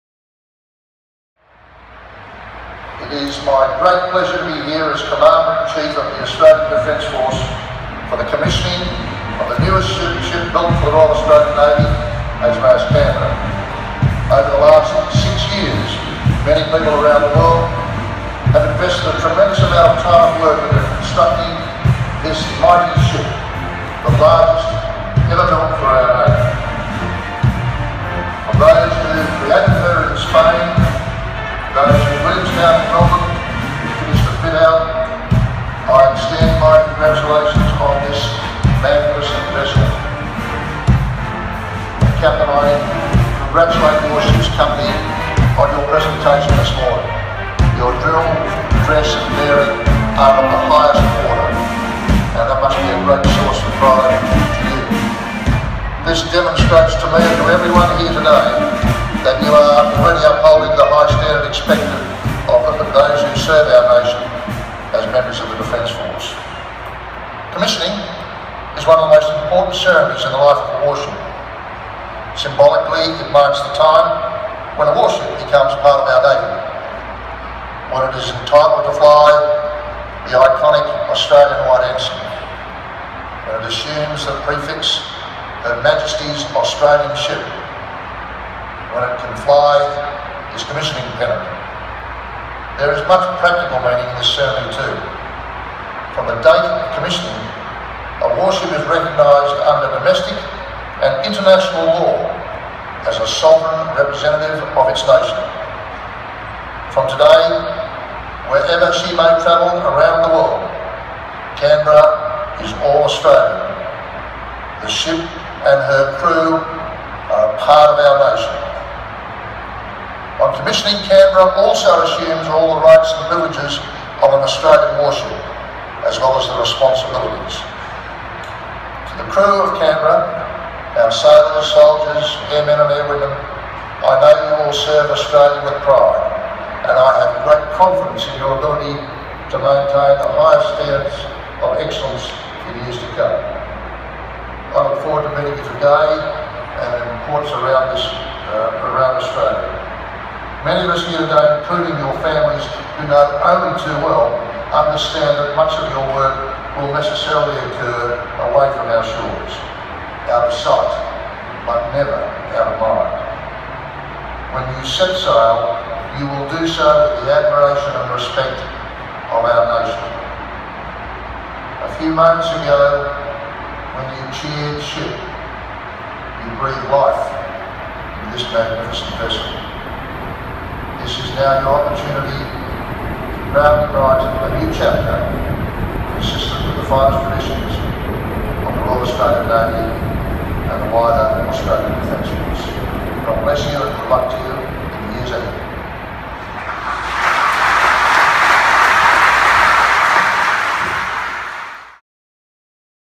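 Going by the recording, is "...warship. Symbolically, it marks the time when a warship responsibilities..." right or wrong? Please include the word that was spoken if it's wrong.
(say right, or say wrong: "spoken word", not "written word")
wrong: "becomes", not "responsibilities".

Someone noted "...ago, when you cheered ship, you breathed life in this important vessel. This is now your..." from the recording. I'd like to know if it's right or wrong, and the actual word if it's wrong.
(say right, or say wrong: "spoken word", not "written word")
wrong: "magnificent", not "important".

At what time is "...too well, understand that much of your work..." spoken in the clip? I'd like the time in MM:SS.
02:33.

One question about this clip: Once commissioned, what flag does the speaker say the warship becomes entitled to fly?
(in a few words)
Australian White Ensign.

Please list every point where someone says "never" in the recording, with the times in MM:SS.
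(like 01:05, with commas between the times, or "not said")
02:41.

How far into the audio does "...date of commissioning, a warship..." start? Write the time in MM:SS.
01:36.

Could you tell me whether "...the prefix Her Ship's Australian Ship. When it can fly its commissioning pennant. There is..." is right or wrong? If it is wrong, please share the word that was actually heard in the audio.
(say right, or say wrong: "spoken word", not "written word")
wrong: "Majesty", not "Ship".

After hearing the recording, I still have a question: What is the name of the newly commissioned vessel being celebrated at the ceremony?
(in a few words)
HMAS Canberra.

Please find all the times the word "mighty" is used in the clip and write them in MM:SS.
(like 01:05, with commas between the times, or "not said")
00:22.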